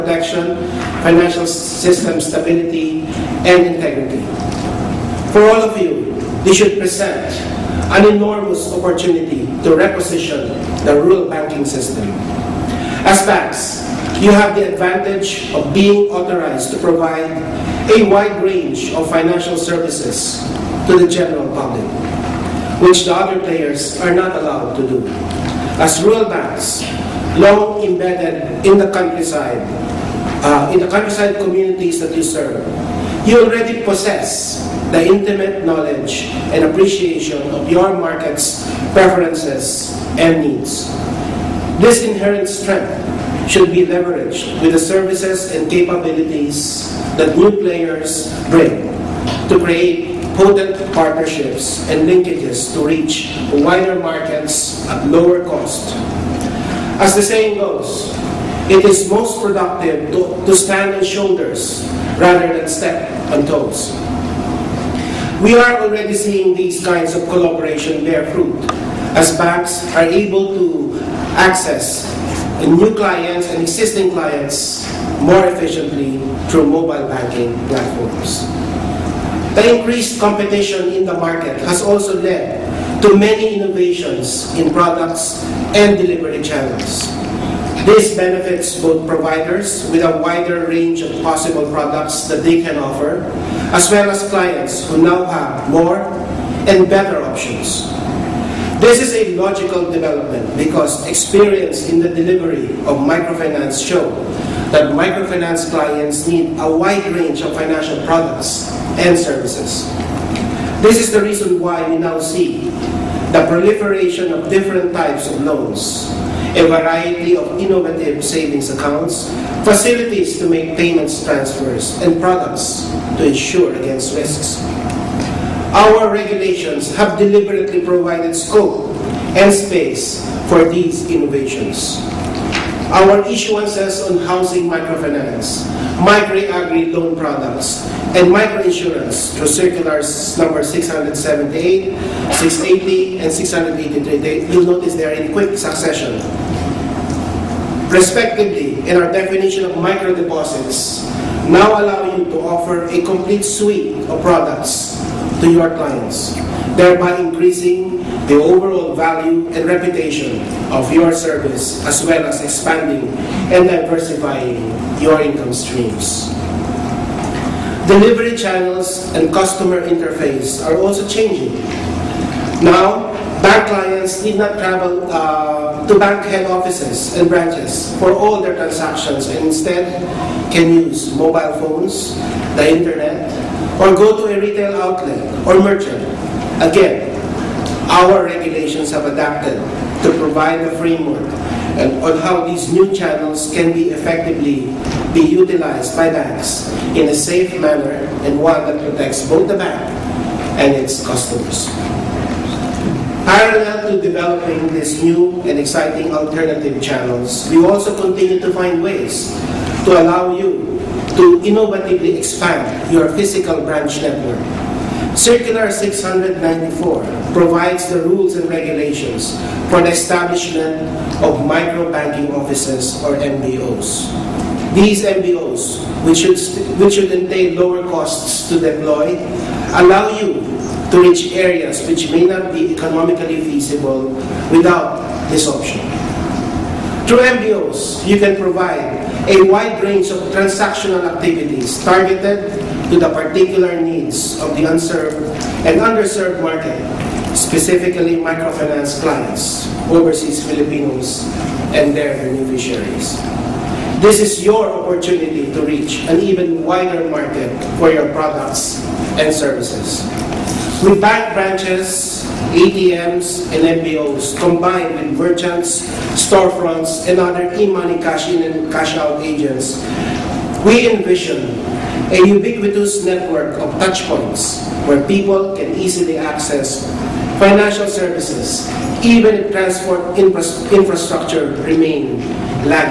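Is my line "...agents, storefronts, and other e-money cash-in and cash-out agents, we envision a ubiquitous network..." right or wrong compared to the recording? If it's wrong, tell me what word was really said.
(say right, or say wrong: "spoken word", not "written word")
wrong: "merchants", not "agents".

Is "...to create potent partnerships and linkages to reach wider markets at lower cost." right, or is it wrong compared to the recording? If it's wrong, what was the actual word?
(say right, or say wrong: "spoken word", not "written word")
right.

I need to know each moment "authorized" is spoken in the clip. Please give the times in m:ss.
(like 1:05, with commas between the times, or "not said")
0:16.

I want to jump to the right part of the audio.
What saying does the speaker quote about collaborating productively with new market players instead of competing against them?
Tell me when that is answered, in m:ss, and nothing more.
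1:00.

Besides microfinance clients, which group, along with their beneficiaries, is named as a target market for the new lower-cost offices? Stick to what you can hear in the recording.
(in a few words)
overseas Filipinos.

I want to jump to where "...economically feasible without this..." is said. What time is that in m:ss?
3:52.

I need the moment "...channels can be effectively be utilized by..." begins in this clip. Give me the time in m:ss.
3:12.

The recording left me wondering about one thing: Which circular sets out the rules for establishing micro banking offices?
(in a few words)
Circular 694.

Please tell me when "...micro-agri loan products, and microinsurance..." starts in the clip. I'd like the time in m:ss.
2:16.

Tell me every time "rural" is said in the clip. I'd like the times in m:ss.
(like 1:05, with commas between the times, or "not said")
0:10, 0:26.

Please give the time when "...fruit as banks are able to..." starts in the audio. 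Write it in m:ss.
1:08.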